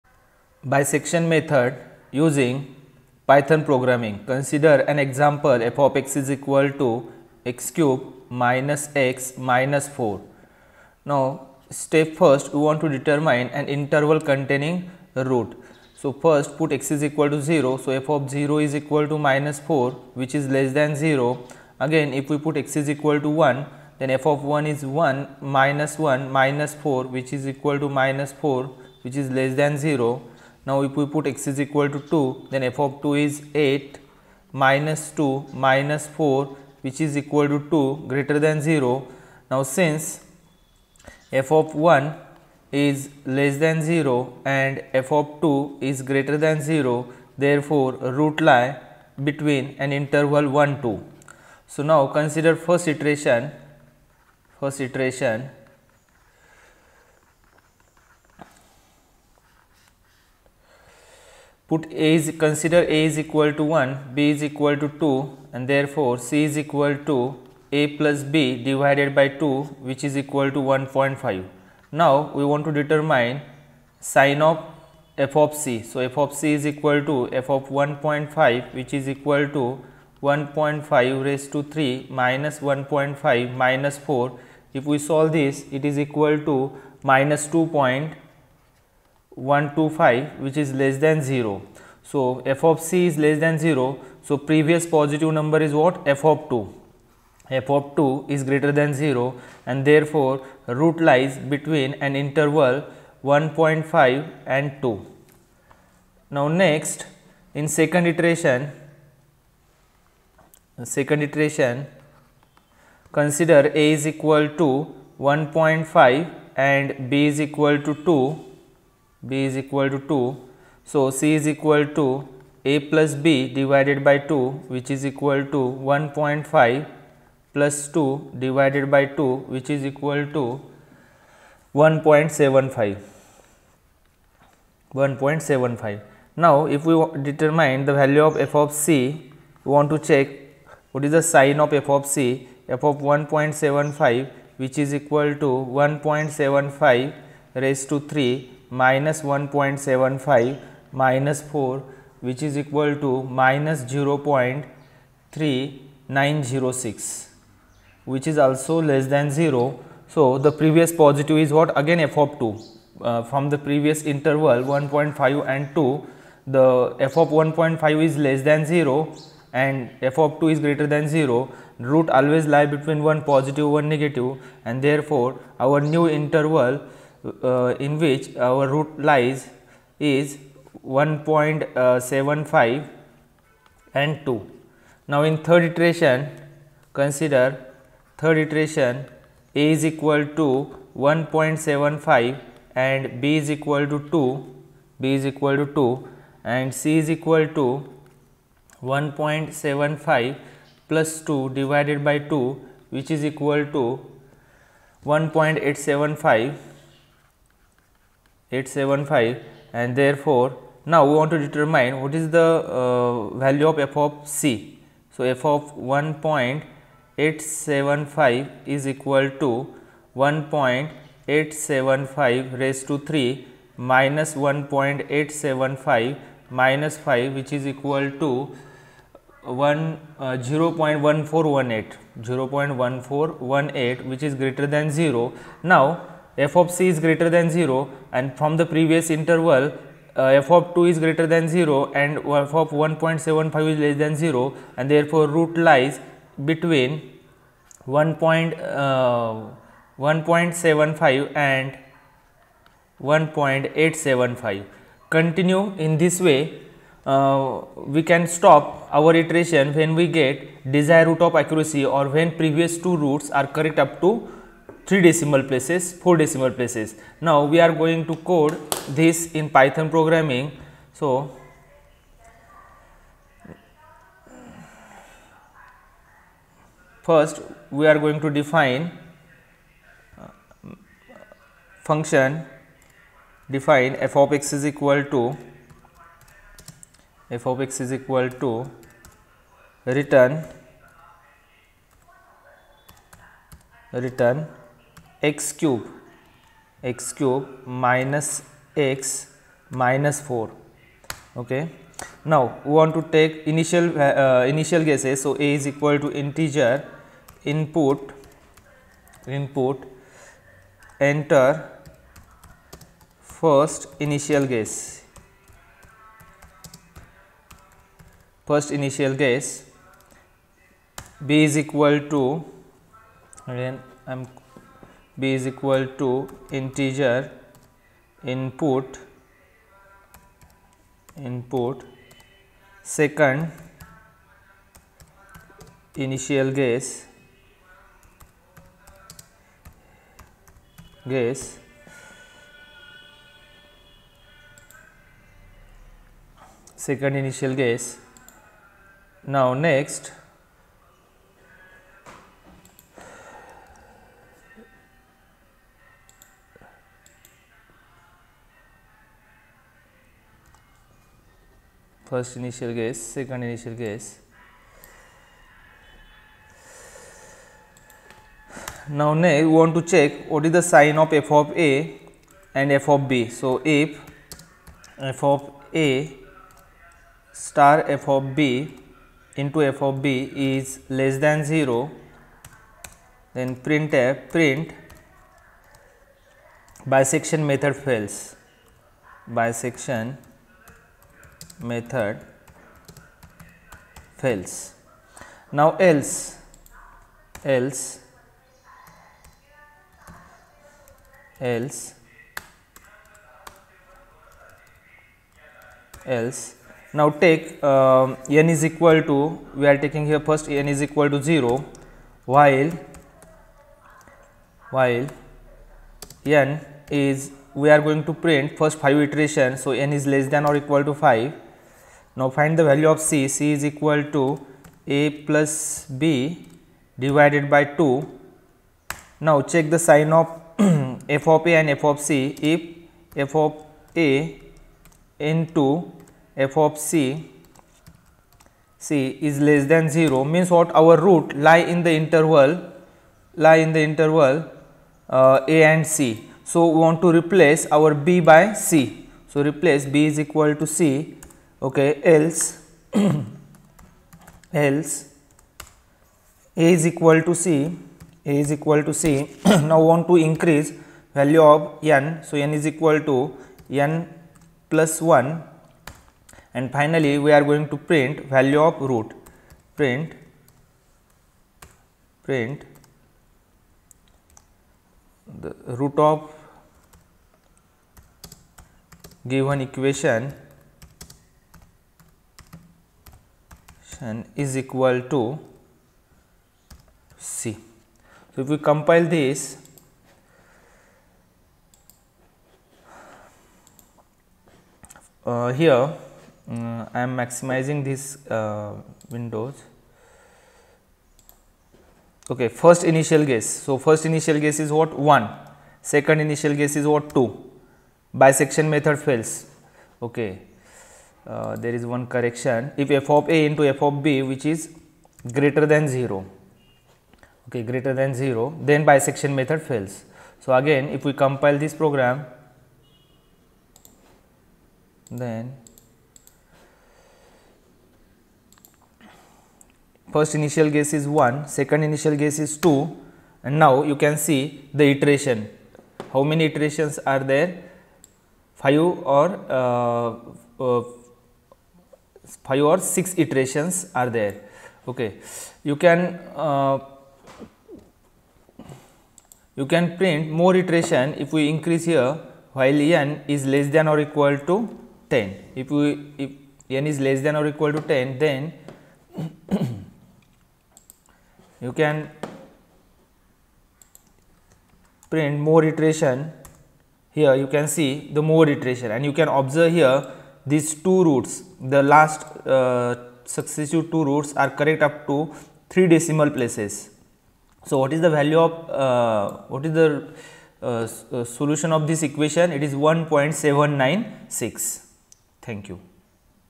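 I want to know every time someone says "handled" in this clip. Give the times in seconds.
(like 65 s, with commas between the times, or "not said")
not said.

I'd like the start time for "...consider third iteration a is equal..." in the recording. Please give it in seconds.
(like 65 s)
186 s.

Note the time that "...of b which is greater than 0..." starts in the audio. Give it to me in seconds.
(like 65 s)
513 s.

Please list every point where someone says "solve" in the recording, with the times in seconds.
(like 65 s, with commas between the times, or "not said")
85 s.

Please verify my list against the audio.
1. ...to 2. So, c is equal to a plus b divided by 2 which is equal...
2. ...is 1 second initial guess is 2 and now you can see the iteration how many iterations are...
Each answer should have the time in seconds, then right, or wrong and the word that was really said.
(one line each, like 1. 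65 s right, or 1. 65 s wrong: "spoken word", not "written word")
1. 119 s right
2. 530 s right.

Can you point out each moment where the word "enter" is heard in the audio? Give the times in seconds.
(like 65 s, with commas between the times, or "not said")
311 s.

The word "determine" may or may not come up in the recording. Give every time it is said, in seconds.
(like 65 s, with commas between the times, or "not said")
12 s, 72 s, 137 s, 211 s.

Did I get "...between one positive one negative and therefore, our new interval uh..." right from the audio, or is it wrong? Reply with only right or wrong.
right.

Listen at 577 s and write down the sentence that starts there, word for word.
So, what is the value of, uh, what is the uh, uh solution of this equation?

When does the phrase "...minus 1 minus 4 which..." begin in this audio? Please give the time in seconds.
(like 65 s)
25 s.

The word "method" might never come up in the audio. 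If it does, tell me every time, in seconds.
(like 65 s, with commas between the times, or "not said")
1 s, 387 s, 391 s, 508 s, 519 s.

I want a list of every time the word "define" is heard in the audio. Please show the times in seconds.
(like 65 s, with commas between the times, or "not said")
278 s, 283 s.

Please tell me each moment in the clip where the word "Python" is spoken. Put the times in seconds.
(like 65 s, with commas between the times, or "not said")
3 s, 269 s.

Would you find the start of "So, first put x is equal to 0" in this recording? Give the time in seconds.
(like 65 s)
15 s.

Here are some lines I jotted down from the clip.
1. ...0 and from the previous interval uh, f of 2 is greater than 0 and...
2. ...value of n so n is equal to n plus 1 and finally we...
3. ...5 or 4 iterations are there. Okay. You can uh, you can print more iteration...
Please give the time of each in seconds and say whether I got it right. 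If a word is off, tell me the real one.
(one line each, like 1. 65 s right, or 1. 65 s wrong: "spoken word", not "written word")
1. 237 s right
2. 461 s right
3. 542 s wrong: "6", not "4".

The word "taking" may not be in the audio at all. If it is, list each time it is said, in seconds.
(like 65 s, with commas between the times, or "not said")
409 s.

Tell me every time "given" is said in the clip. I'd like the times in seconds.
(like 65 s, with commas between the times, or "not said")
479 s.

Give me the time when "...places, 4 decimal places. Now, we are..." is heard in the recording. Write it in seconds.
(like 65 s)
265 s.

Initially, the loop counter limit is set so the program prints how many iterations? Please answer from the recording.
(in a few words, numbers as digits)
5.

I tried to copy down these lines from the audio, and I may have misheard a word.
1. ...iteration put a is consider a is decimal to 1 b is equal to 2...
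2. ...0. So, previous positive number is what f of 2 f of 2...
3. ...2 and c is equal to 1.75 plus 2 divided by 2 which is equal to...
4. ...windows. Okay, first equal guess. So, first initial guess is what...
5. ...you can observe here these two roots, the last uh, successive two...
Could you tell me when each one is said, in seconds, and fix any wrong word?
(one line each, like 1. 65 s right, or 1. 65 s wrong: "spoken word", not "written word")
1. 54 s wrong: "equal", not "decimal"
2. 93 s right
3. 195 s right
4. 499 s wrong: "initial", not "equal"
5. 569 s right.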